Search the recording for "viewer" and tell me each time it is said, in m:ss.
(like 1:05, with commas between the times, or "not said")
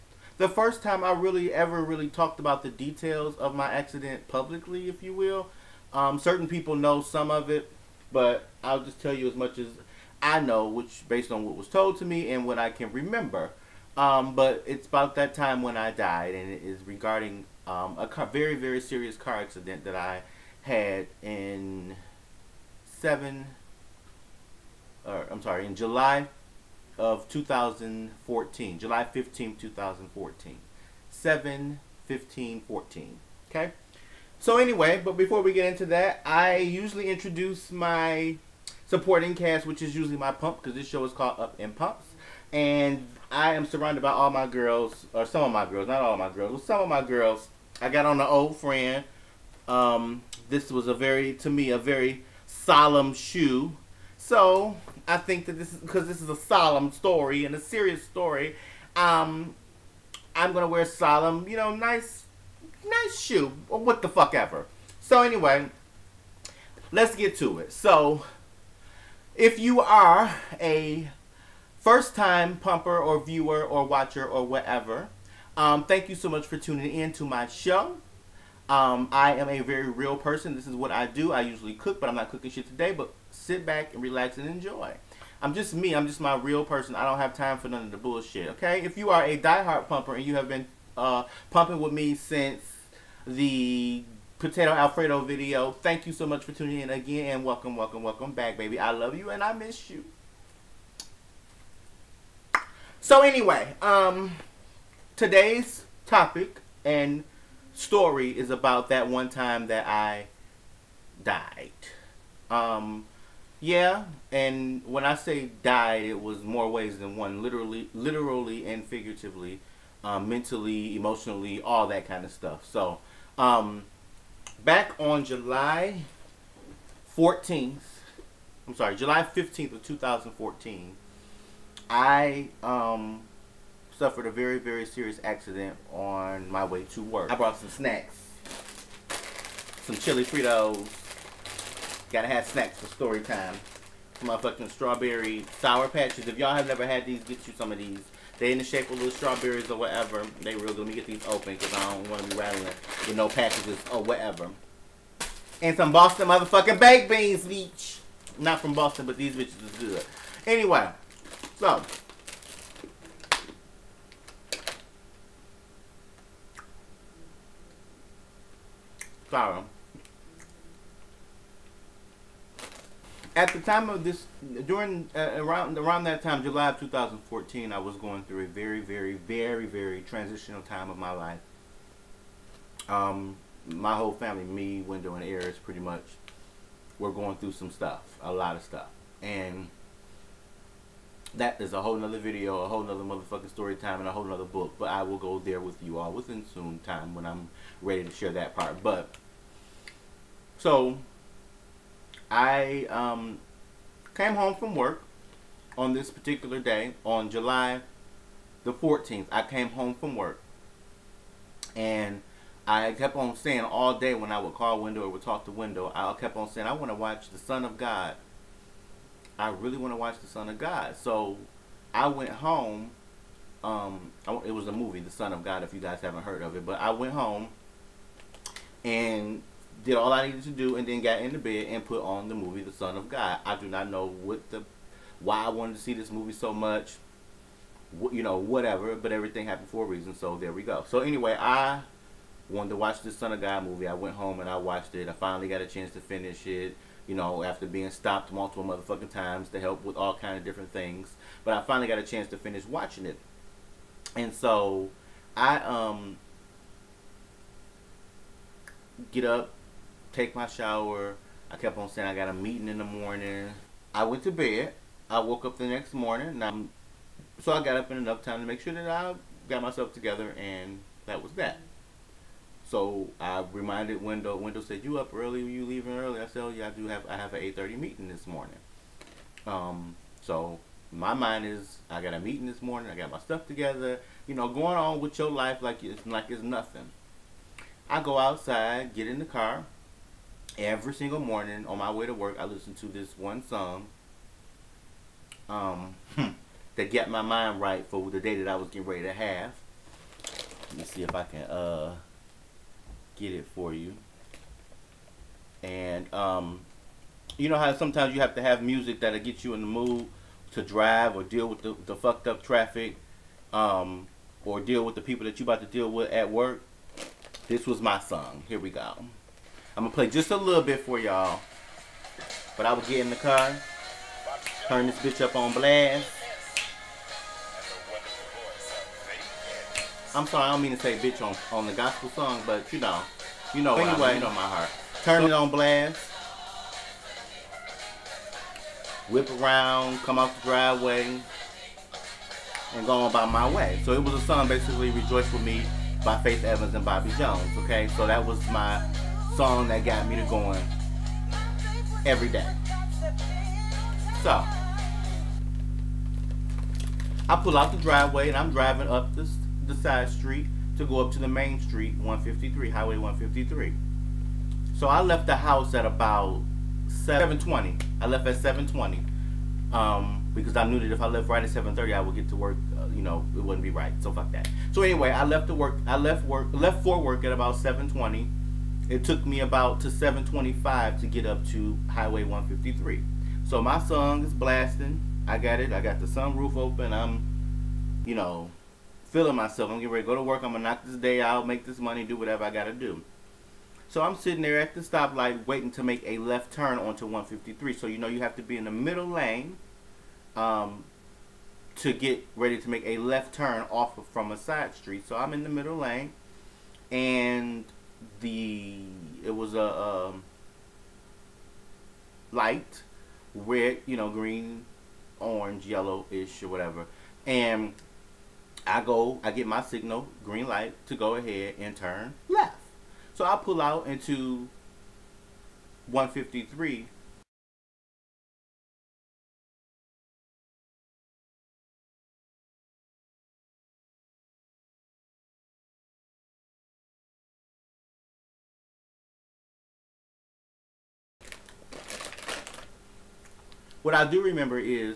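1:13.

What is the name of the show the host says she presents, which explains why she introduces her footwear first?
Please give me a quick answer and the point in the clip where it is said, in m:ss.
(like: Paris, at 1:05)
Up in Pumps, at 0:41.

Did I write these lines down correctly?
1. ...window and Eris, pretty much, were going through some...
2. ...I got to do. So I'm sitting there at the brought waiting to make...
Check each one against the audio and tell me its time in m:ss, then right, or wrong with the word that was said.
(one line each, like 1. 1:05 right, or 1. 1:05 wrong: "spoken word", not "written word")
1. 3:04 right
2. 6:32 wrong: "stoplight", not "brought".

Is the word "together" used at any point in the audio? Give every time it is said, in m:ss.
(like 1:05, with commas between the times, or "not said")
4:29, 4:43.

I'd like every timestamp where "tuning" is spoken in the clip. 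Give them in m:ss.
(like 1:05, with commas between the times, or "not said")
1:16, 1:36.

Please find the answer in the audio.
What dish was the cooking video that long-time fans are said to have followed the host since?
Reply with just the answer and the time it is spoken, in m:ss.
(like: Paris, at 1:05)
potato alfredo, at 1:34.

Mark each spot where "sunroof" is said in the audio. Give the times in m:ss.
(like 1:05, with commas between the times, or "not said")
6:26.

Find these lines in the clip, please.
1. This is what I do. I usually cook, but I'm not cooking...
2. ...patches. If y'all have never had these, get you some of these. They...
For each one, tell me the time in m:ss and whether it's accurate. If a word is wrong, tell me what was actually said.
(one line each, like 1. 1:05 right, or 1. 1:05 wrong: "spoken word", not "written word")
1. 1:20 right
2. 2:25 right.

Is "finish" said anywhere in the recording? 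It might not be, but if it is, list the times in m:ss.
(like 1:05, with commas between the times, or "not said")
4:05, 4:12.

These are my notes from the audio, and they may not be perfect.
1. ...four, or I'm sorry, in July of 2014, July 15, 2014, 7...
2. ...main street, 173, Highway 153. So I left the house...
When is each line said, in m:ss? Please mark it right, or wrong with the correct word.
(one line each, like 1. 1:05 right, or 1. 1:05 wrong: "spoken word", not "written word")
1. 0:22 wrong: "seven", not "four"
2. 6:01 wrong: "153", not "173".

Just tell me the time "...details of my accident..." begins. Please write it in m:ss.
0:02.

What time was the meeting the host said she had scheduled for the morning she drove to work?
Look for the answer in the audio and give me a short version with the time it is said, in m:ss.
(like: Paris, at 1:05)
8:30, at 4:37.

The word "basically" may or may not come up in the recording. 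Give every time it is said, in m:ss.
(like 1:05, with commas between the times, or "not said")
5:44.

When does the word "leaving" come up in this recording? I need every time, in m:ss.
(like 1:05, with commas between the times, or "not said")
4:35.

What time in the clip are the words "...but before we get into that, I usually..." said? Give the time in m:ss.
0:35.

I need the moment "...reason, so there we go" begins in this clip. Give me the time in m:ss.
3:59.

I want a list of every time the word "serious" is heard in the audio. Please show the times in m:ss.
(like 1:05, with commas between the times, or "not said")
0:18, 0:57, 2:14.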